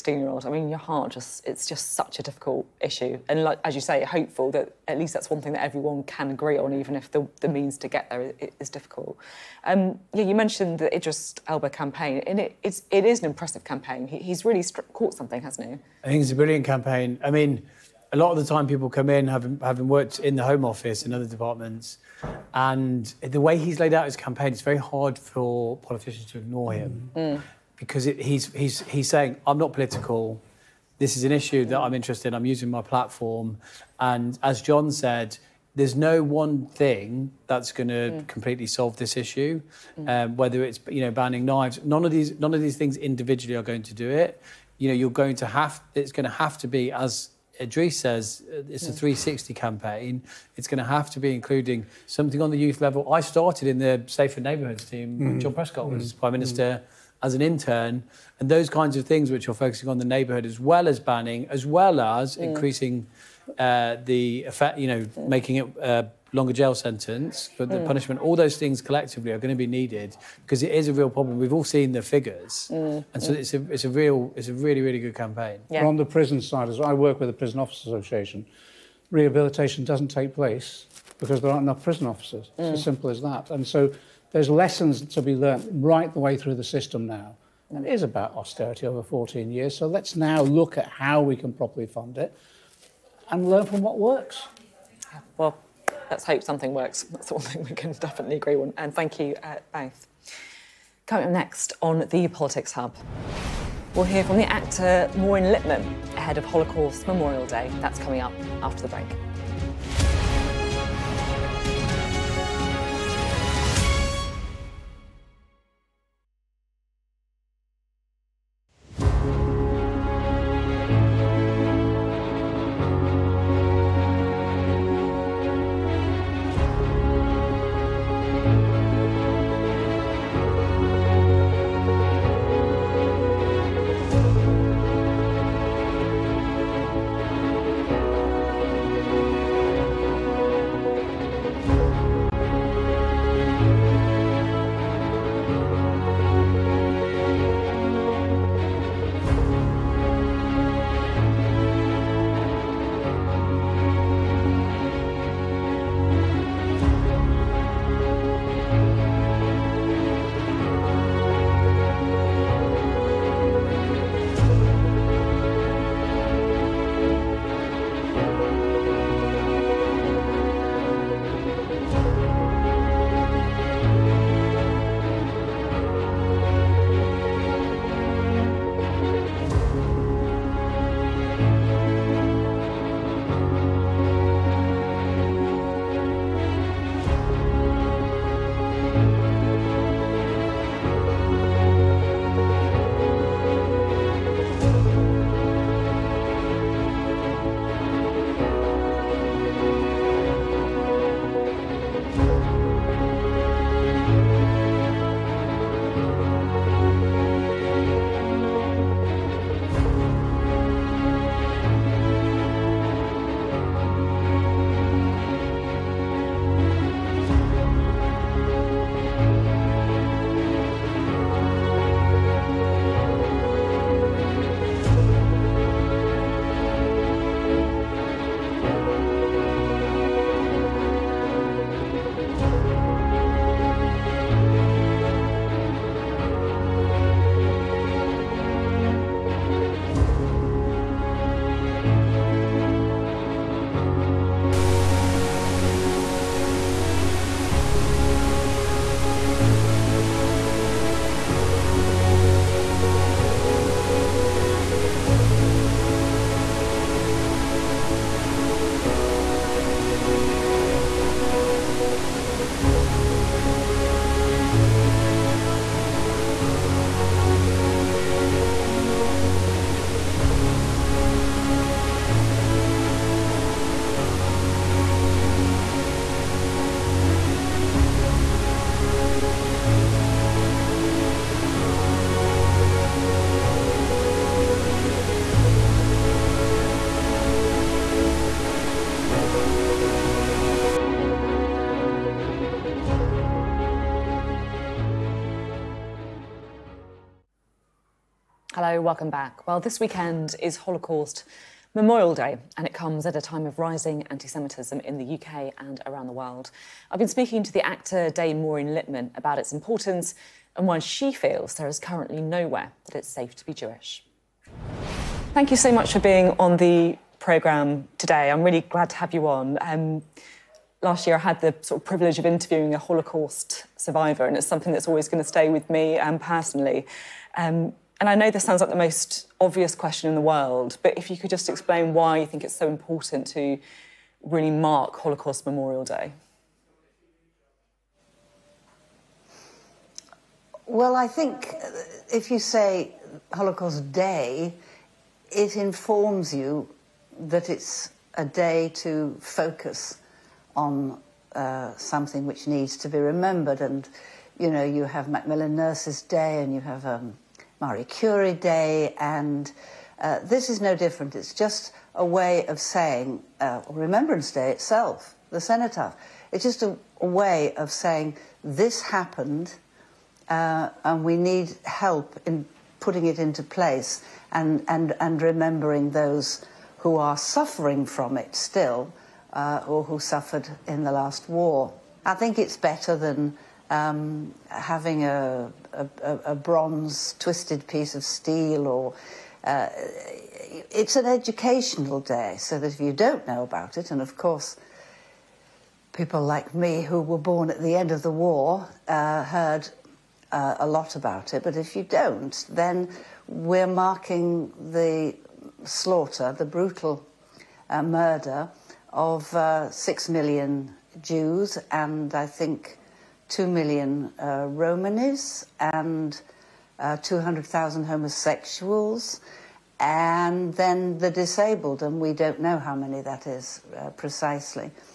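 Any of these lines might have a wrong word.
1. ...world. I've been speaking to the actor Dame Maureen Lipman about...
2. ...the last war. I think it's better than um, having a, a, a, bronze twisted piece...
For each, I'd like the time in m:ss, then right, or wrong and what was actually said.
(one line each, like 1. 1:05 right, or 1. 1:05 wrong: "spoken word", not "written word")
1. 5:06 right
2. 6:20 right.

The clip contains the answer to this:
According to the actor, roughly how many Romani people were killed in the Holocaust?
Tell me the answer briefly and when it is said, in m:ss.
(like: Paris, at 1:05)
2 million, at 6:53.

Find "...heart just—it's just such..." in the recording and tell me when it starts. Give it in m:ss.
0:00.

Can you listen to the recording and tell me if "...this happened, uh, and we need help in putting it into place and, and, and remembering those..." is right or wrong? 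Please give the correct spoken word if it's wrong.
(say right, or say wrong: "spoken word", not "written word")
right.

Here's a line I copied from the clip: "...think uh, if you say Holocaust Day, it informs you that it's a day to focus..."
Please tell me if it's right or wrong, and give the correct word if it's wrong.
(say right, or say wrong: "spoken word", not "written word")
right.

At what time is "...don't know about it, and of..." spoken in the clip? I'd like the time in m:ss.
6:32.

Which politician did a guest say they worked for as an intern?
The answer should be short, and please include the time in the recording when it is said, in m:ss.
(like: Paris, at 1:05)
John Prescott, at 0:55.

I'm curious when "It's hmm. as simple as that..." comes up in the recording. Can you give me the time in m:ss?
1:22.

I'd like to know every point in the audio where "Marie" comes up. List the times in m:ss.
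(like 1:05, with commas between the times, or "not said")
5:57.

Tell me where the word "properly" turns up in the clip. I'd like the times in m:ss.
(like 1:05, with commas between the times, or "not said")
1:31.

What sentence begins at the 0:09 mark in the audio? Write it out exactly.
Um, yeah, you mentioned the Idris Elba campaign, and it, it's it is an impressive campaign.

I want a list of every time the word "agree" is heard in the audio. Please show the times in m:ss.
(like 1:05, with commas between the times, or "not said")
0:06, 1:38.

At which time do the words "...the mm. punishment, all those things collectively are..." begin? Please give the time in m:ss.
1:07.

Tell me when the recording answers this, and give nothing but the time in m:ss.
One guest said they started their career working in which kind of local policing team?
0:54.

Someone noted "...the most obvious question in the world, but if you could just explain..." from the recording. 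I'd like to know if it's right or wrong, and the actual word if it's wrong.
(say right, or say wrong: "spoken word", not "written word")
right.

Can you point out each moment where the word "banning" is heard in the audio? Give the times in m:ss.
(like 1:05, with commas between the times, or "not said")
0:41, 1:00.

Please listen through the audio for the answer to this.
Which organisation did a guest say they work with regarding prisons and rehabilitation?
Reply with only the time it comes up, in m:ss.
1:17.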